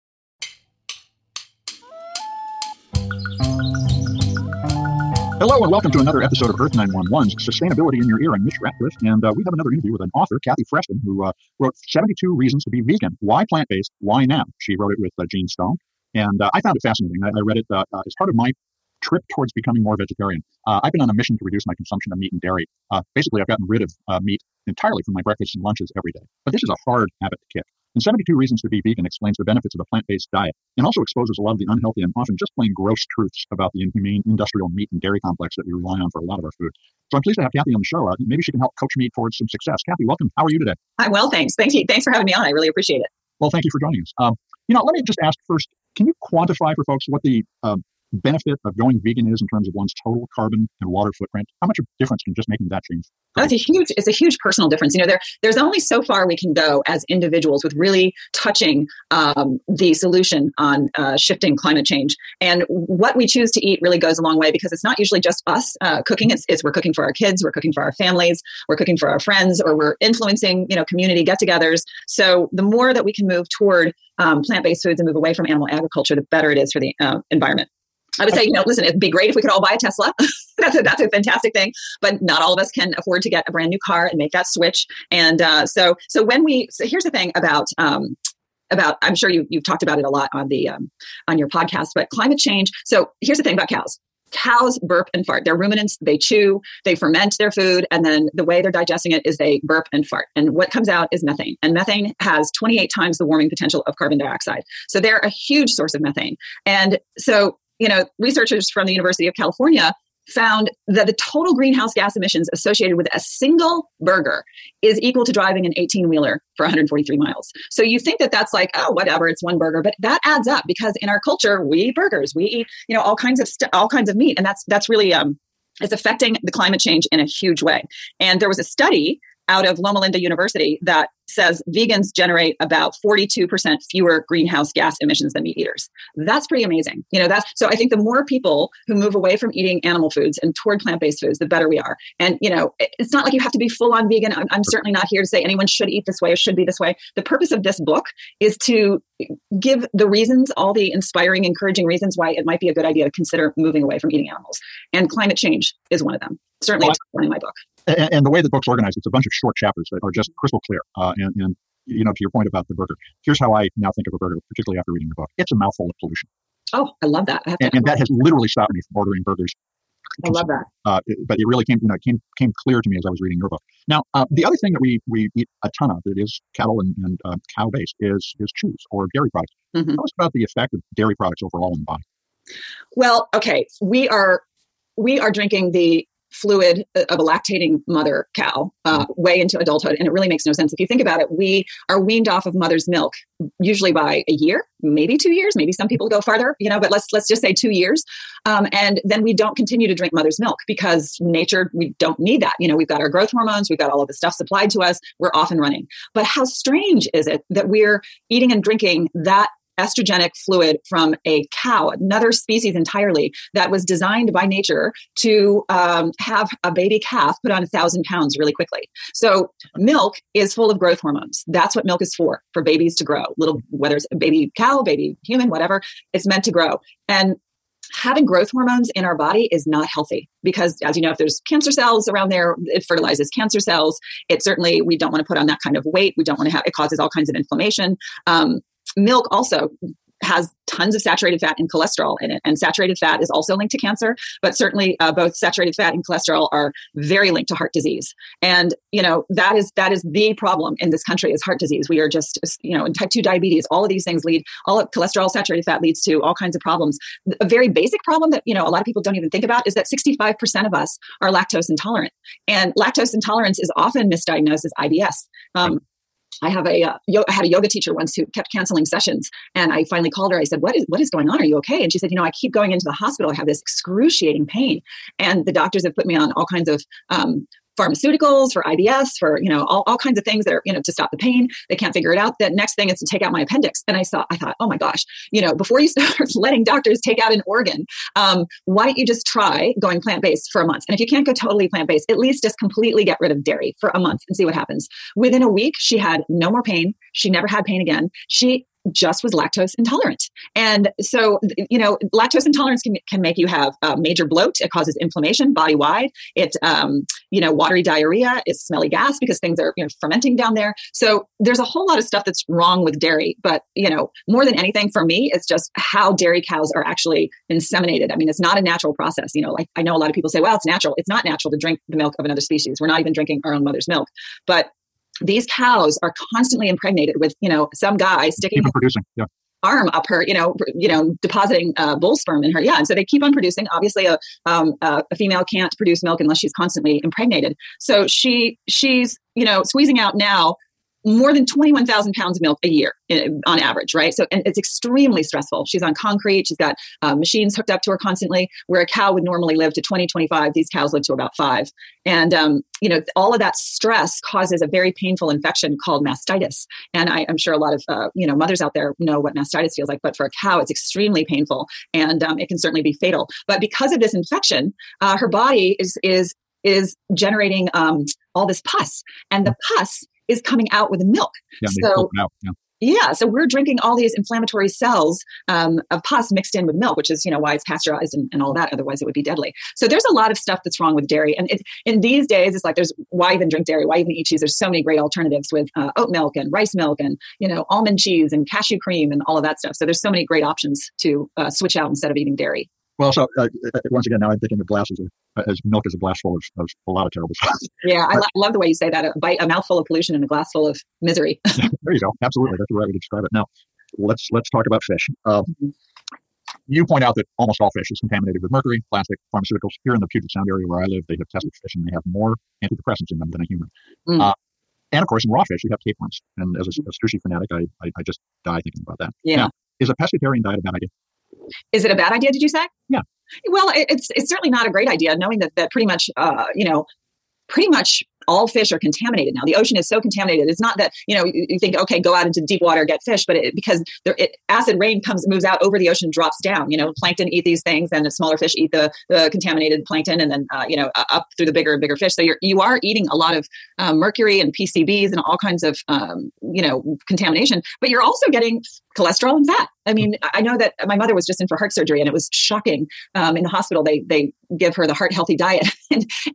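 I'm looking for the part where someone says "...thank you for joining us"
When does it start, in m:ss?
0:43.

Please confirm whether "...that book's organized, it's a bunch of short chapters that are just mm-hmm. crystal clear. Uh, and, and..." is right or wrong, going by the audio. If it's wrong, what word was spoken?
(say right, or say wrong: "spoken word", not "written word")
right.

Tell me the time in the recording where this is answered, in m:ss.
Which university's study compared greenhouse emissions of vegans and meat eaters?
2:09.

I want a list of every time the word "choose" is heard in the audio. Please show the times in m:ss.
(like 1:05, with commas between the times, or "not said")
1:03.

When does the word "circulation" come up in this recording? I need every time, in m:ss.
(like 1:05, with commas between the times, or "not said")
not said.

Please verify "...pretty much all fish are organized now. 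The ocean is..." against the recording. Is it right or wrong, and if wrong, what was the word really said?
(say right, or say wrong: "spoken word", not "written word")
wrong: "contaminated", not "organized".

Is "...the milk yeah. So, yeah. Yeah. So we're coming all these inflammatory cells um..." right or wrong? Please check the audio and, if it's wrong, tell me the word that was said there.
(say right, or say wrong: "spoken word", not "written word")
wrong: "drinking", not "coming".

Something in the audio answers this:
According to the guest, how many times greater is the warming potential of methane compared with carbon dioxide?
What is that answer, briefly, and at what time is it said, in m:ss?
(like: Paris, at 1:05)
28, at 1:42.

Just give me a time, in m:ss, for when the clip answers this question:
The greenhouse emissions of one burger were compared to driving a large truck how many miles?
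1:56.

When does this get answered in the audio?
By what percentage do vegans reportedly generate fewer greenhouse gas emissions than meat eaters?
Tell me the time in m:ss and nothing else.
2:13.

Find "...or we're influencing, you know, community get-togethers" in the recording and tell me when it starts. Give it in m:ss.
1:09.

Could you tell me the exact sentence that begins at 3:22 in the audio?
You know, we've got our growth hormones, we've got all of the stuff supplied to us, we're off and running.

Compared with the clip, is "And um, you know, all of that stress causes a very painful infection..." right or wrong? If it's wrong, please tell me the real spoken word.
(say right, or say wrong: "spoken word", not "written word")
right.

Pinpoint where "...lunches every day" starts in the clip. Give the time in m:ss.
0:25.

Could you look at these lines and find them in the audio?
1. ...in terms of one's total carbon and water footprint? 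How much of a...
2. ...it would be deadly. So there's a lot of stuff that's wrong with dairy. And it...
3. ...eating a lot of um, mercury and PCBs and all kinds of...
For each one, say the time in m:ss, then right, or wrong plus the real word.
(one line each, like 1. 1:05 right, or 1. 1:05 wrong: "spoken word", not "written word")
1. 0:49 right
2. 6:19 right
3. 7:22 right.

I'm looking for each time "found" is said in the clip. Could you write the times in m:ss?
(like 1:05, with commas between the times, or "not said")
0:16, 1:50.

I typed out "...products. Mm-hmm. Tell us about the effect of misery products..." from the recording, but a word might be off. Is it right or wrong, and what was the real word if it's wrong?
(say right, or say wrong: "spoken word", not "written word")
wrong: "dairy", not "misery".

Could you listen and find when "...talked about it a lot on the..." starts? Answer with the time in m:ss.
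1:29.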